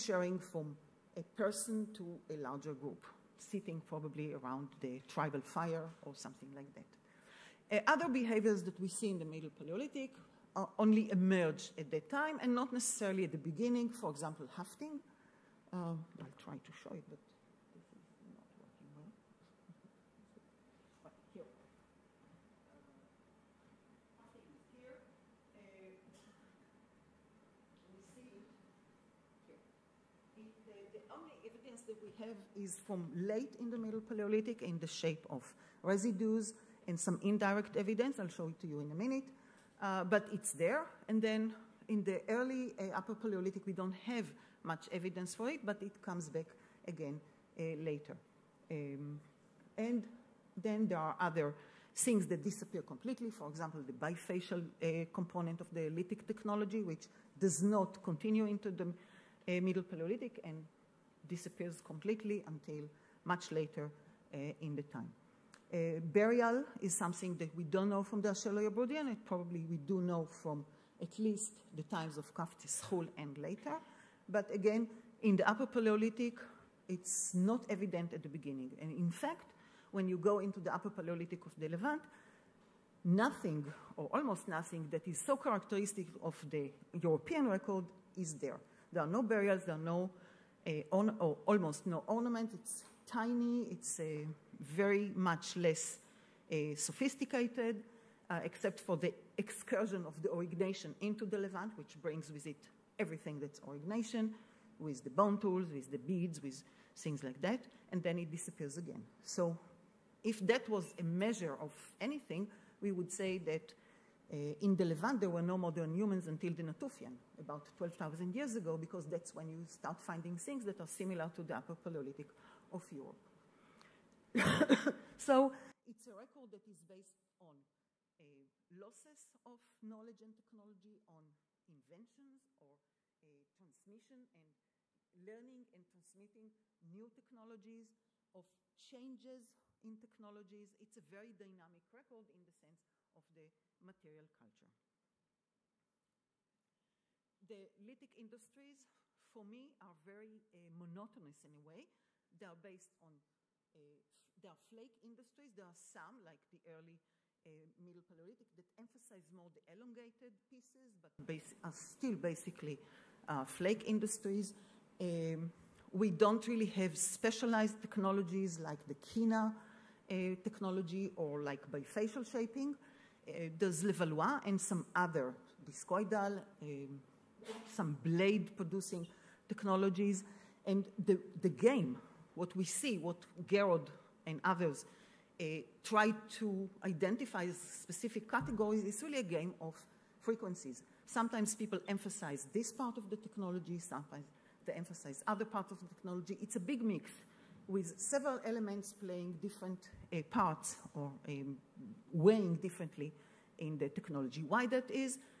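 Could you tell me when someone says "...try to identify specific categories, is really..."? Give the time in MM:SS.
03:05.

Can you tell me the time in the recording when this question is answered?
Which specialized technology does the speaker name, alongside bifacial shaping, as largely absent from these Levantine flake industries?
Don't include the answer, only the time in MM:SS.
02:48.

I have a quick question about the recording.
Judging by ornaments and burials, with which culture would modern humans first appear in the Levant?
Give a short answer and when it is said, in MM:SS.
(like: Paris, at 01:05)
Natufian, at 01:56.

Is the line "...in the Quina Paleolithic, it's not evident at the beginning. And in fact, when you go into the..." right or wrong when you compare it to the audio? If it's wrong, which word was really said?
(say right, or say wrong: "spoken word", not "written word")
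wrong: "Upper", not "Quina".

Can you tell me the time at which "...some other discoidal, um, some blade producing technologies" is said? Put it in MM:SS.
02:54.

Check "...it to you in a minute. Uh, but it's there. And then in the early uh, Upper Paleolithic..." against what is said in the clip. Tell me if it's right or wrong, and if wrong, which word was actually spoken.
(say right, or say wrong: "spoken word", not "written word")
right.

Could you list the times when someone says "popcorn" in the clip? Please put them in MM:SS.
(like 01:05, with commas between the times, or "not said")
not said.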